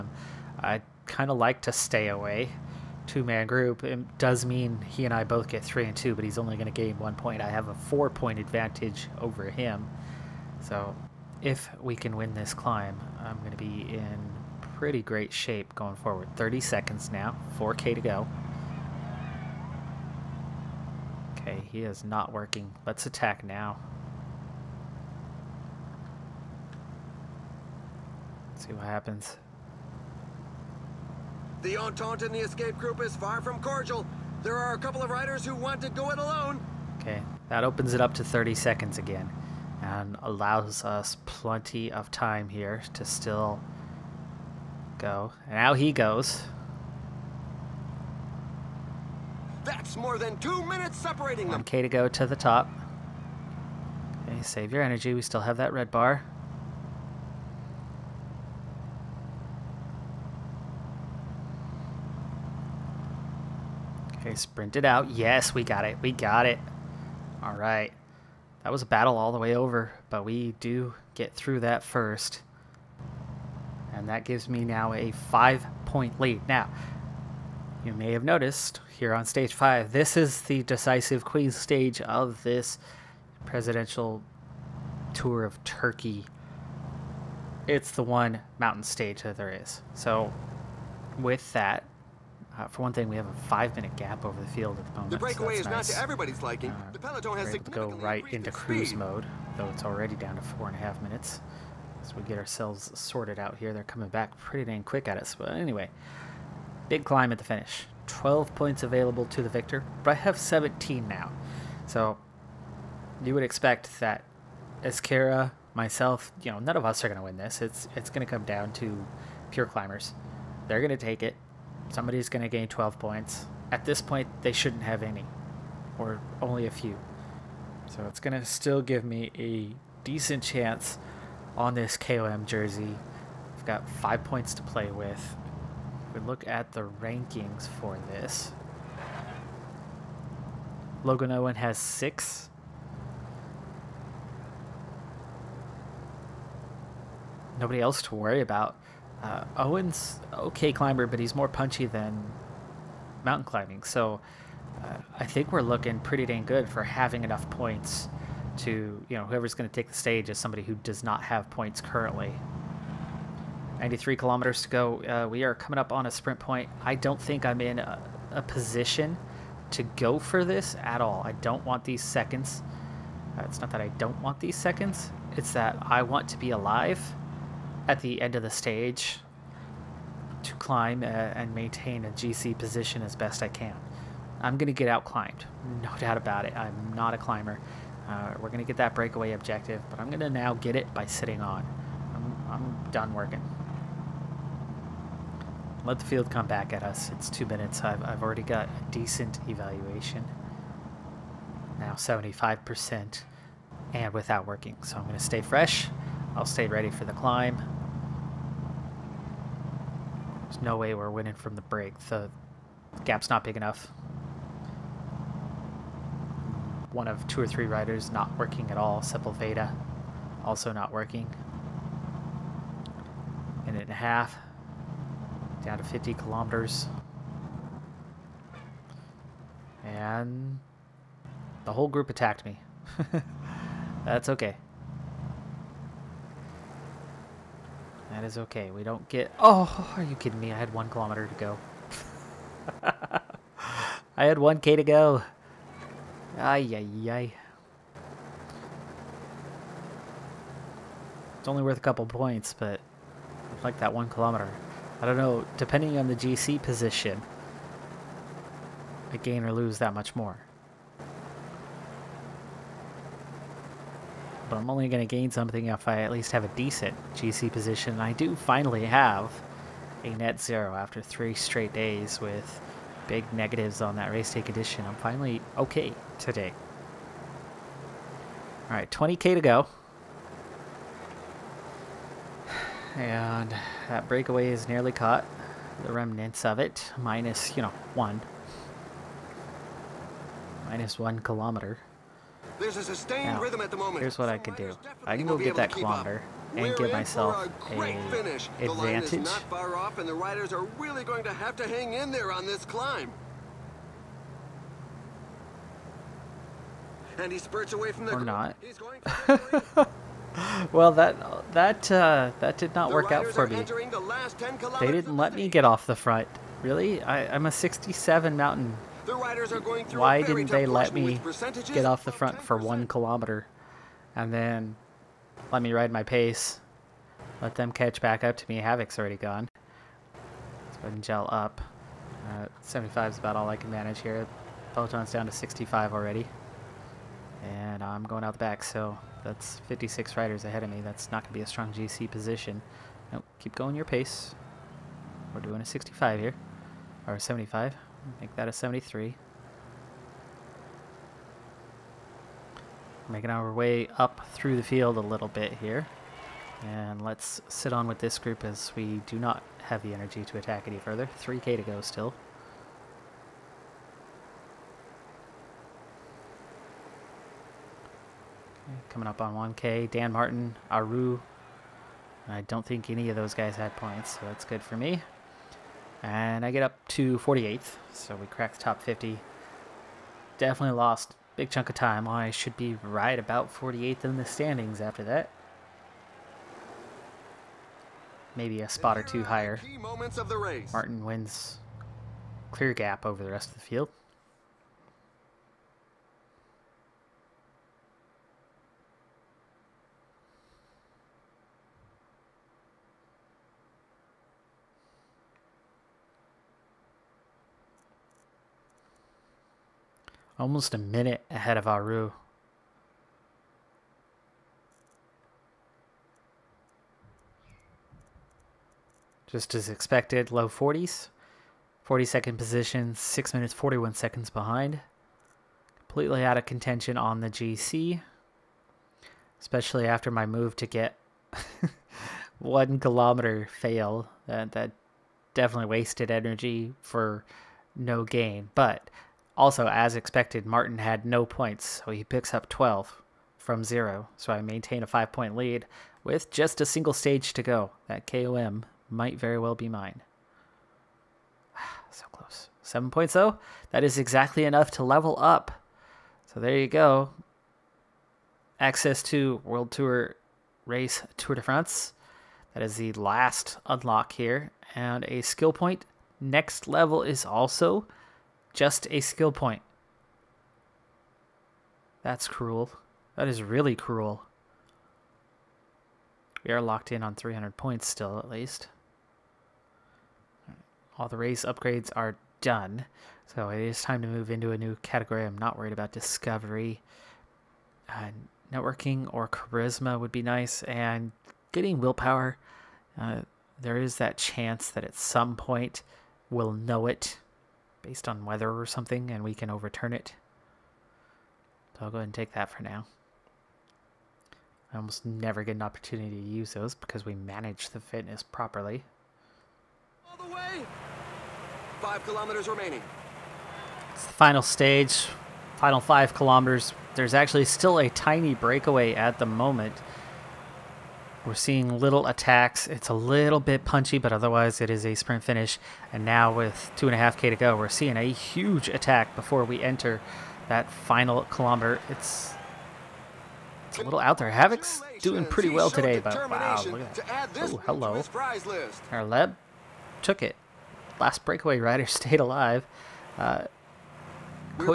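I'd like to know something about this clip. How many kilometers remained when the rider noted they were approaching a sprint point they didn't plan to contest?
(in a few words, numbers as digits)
93.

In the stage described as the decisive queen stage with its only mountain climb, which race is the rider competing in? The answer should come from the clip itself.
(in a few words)
Presidential Tour of Turkey.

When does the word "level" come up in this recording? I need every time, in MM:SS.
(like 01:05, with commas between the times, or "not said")
07:34, 07:46.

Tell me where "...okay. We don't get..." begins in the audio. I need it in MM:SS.
03:58.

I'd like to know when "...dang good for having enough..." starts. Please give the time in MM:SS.
02:36.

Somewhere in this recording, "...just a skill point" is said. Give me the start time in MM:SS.
07:48.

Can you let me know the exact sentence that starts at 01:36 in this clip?
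Uh, the peloton has to go right into cruise speed.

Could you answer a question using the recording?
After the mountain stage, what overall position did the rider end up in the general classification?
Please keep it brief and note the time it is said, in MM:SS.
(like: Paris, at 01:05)
42nd, at 07:01.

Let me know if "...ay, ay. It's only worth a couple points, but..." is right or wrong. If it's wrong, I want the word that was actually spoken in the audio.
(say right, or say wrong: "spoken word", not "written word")
right.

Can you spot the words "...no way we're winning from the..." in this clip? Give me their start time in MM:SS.
03:30.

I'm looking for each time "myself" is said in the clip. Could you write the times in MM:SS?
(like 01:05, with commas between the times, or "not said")
01:55, 04:56.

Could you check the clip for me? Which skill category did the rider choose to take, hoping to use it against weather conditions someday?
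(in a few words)
Willpower.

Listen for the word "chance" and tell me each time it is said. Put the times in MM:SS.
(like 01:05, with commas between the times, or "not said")
02:10, 08:14.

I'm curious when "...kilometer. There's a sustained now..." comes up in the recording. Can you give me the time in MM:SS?
04:51.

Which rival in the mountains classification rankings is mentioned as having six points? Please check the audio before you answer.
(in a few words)
Logan Owen.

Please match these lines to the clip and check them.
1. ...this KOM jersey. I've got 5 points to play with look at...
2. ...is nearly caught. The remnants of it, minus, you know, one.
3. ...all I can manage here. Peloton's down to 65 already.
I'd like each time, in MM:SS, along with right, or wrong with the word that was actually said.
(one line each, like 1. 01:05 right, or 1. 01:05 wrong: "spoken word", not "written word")
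1. 02:11 right
2. 04:44 right
3. 05:33 right.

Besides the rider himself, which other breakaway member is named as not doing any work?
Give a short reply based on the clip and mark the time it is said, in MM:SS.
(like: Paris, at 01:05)
Sepulveda, at 03:38.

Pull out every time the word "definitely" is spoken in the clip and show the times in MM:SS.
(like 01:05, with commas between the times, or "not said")
06:20, 07:15.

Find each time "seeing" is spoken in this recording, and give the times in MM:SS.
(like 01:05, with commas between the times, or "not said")
08:41, 08:47.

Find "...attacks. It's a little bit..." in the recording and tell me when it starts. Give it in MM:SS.
08:42.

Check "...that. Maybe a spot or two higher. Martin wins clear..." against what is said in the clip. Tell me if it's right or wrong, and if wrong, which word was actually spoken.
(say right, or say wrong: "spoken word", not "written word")
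right.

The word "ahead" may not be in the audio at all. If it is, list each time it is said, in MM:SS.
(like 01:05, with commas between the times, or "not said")
05:30, 05:40, 06:51, 08:21.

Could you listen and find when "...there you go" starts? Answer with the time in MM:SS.
07:36.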